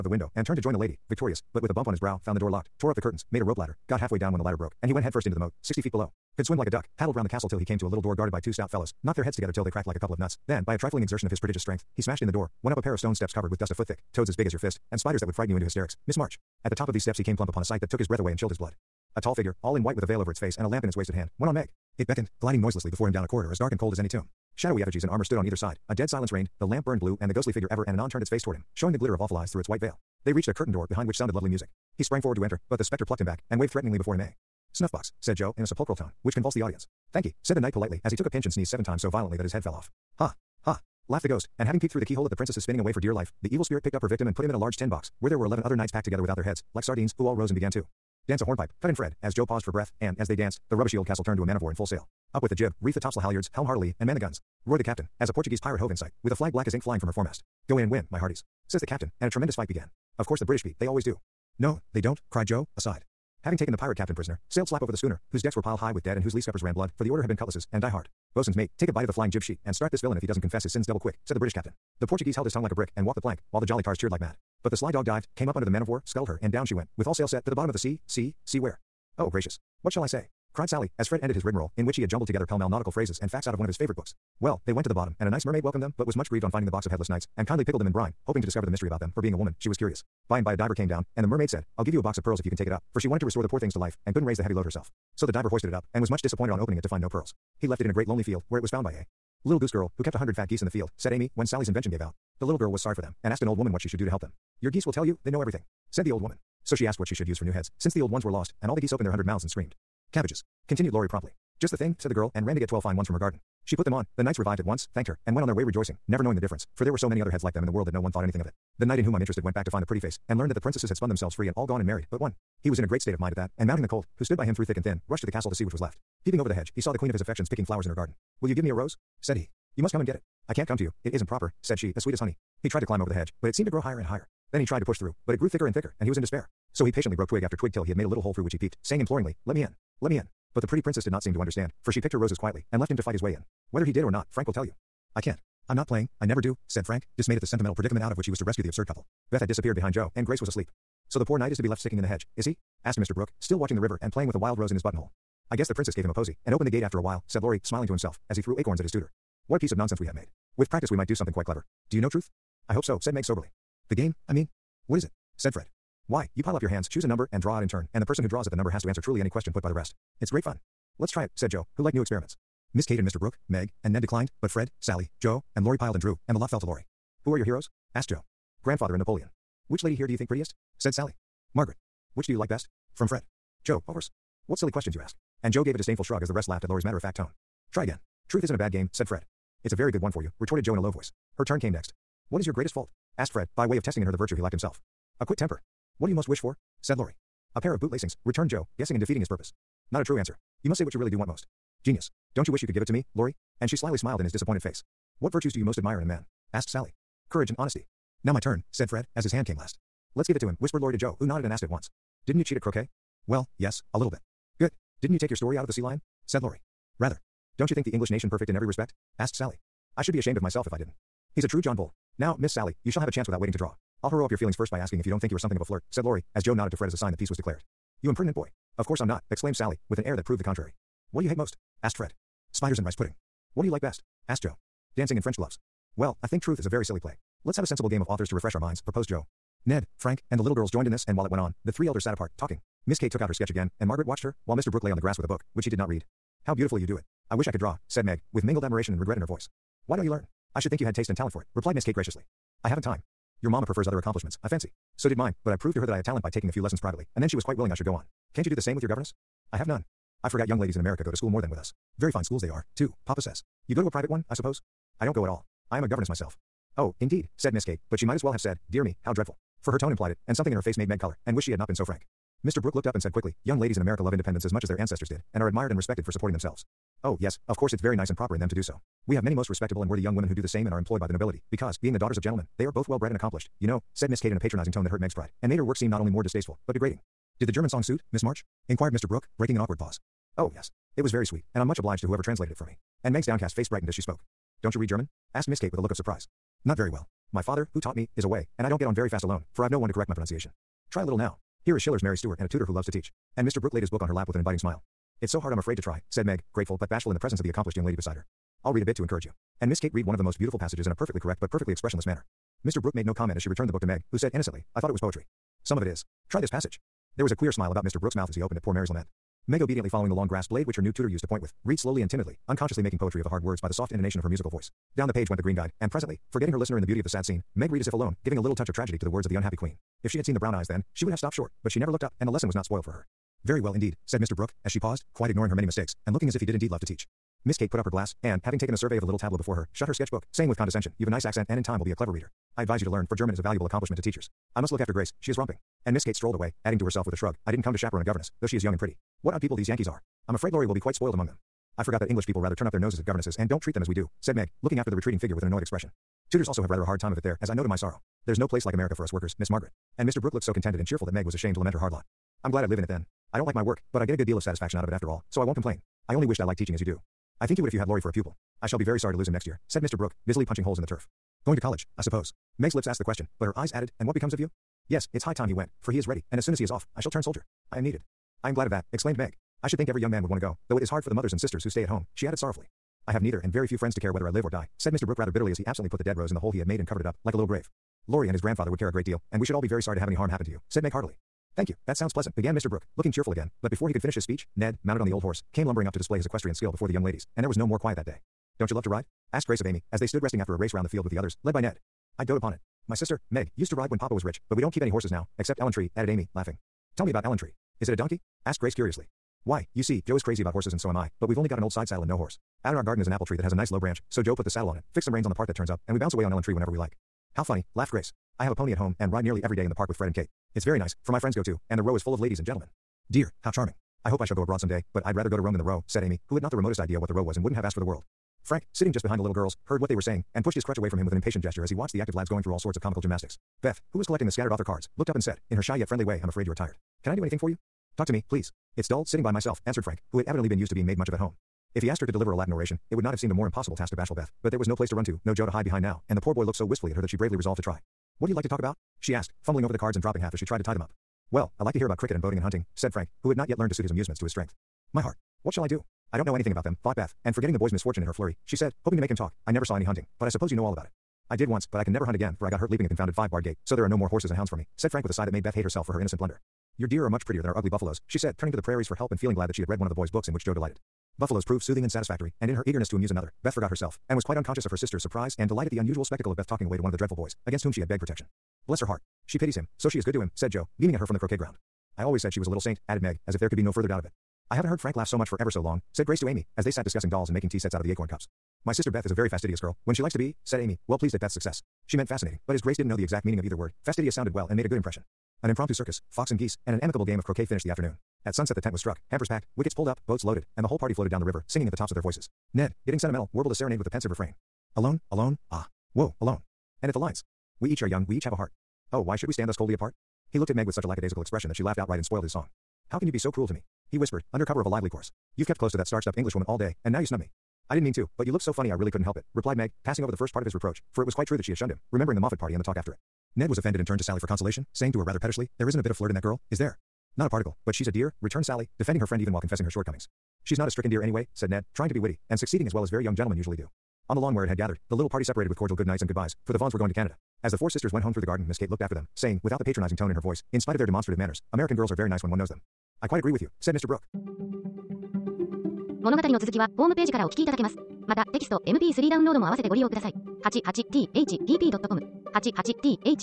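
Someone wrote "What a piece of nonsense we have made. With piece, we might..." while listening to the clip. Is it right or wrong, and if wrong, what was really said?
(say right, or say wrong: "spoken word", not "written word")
wrong: "practice", not "piece".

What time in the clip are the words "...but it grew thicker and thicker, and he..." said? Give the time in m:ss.
2:15.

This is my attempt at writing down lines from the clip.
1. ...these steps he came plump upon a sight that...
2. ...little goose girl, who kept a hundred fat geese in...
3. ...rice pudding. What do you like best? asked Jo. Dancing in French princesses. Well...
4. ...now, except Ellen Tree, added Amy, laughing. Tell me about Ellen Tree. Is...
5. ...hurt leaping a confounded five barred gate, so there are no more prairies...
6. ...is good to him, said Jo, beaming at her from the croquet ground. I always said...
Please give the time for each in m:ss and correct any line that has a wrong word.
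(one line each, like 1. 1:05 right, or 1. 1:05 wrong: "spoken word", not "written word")
1. 0:16 right
2. 1:39 right
3. 3:52 wrong: "gloves", not "princesses"
4. 6:45 right
5. 7:42 wrong: "horses", not "prairies"
6. 7:59 right.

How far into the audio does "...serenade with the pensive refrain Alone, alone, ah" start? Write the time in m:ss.
8:23.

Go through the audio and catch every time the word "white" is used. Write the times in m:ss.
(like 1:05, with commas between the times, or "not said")
0:19, 0:29.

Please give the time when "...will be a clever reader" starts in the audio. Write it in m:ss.
5:41.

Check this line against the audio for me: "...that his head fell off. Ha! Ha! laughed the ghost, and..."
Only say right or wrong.
right.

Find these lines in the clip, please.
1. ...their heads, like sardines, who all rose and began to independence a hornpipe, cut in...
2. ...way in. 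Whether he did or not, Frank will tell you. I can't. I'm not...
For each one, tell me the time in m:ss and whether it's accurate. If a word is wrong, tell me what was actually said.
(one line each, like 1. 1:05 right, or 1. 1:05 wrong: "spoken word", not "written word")
1. 0:46 wrong: "dance", not "independence"
2. 2:23 right.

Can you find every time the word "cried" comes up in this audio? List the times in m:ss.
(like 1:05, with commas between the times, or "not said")
1:02, 1:20.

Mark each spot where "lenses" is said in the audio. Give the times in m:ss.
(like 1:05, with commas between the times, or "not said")
not said.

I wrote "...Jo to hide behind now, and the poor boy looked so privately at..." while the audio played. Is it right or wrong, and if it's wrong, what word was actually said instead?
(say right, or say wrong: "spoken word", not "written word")
wrong: "wistfully", not "privately".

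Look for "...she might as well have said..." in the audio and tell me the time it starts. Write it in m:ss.
4:27.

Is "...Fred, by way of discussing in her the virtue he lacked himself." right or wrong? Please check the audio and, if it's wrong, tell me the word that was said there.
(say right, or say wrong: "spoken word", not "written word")
wrong: "testing", not "discussing".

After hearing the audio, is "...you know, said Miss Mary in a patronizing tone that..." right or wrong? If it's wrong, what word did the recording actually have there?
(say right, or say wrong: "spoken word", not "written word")
wrong: "Kate", not "Mary".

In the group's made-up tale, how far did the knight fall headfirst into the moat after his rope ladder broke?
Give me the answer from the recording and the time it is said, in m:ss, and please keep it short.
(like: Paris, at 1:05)
60 feet, at 0:05.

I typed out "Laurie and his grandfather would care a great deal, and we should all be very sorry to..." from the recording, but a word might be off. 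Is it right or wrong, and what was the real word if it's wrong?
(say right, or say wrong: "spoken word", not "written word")
right.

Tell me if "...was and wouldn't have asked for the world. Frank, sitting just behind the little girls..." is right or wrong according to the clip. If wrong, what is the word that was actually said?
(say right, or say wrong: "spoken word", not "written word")
right.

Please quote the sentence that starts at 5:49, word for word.
What odd people these Yankees are.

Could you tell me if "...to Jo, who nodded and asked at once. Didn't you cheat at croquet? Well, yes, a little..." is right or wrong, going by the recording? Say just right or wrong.
right.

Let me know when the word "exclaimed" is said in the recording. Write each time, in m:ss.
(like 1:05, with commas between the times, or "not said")
3:49, 6:18.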